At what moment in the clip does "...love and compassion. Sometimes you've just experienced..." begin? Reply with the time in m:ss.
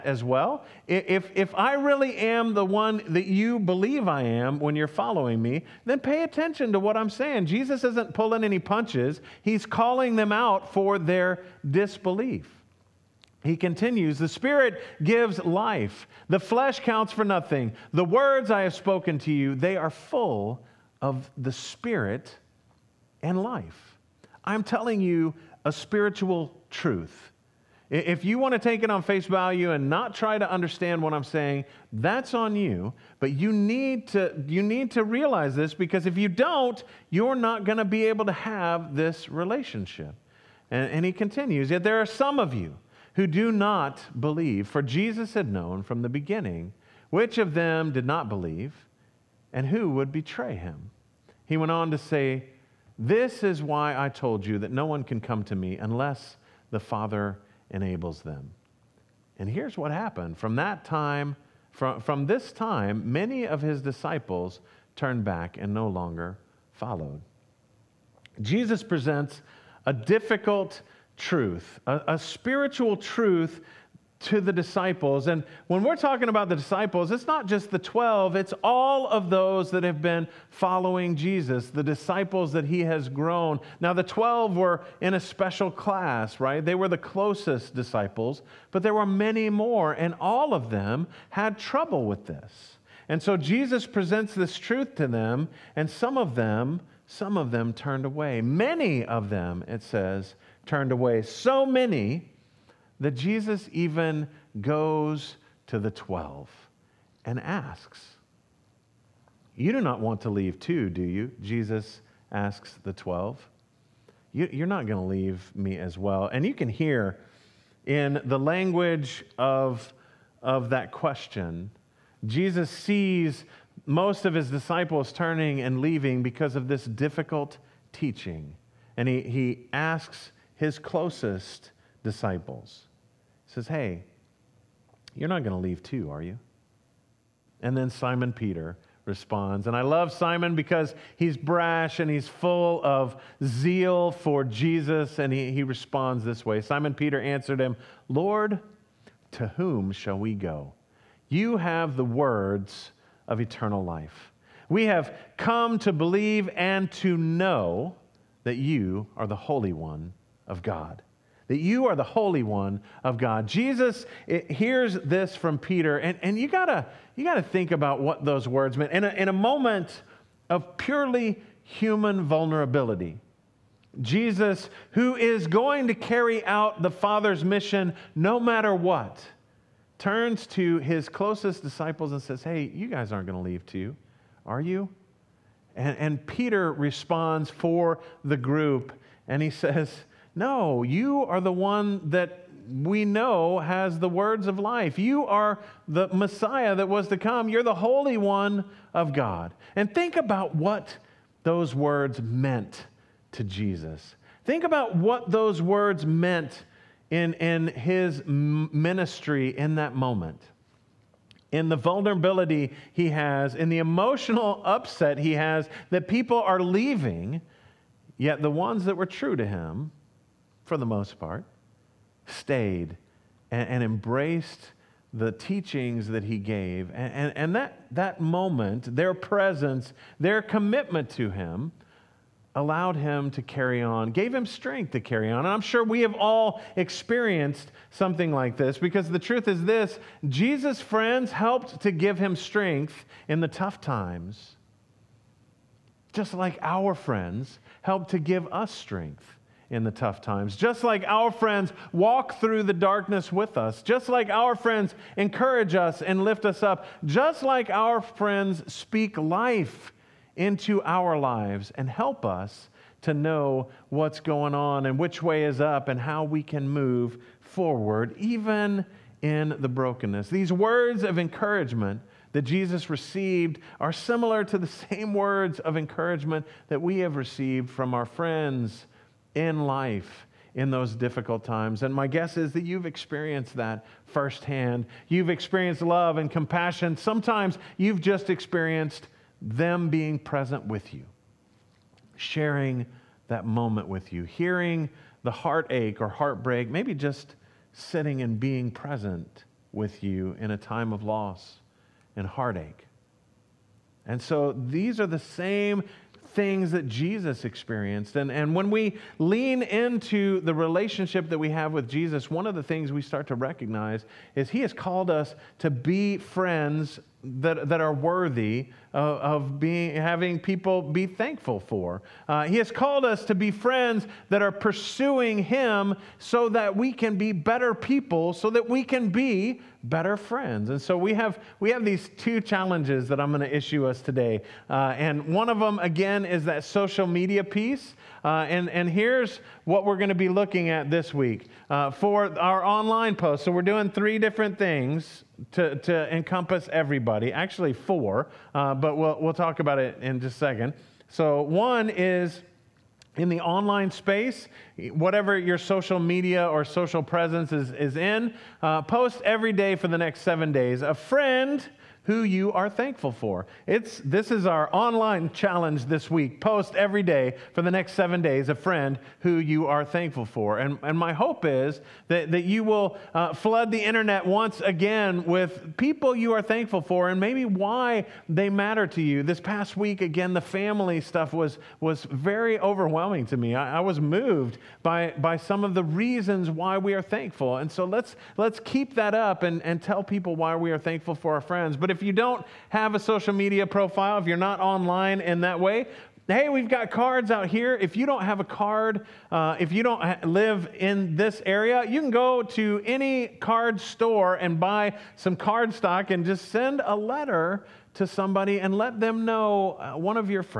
4:45.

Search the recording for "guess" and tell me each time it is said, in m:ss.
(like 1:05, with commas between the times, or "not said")
4:42.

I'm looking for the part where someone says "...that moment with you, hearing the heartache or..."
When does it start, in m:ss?
4:53.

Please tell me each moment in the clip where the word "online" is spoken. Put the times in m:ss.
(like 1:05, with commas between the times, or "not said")
5:42, 5:53, 6:04, 6:34.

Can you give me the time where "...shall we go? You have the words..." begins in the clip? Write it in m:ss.
2:29.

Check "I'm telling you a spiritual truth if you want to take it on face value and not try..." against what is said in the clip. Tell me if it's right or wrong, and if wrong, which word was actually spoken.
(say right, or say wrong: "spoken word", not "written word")
right.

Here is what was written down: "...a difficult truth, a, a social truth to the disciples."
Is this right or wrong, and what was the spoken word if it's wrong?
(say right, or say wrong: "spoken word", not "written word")
wrong: "spiritual", not "social".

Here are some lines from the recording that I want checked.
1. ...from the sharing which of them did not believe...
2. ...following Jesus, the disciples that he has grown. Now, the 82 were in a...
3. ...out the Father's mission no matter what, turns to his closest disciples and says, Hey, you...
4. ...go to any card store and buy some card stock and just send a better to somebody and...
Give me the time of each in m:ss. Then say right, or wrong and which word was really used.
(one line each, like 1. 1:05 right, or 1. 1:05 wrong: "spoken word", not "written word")
1. 0:45 wrong: "beginning", not "sharing"
2. 1:20 wrong: "12", not "82"
3. 2:56 right
4. 6:42 wrong: "letter", not "better".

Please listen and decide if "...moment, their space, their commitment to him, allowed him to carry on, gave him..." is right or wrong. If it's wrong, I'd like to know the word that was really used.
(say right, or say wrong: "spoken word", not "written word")
wrong: "presence", not "space".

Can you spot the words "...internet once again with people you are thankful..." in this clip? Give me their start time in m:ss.
6:13.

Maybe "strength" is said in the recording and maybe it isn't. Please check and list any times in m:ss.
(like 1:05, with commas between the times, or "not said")
3:54, 4:02, 4:08.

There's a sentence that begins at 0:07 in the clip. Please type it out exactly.
Jesus isn't pulling any punches, he's calling them out for their disbelief.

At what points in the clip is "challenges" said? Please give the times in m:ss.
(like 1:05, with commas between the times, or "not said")
5:32, 6:05.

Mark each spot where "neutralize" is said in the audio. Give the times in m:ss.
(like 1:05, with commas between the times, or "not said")
not said.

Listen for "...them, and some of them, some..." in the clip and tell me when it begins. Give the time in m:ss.
1:35.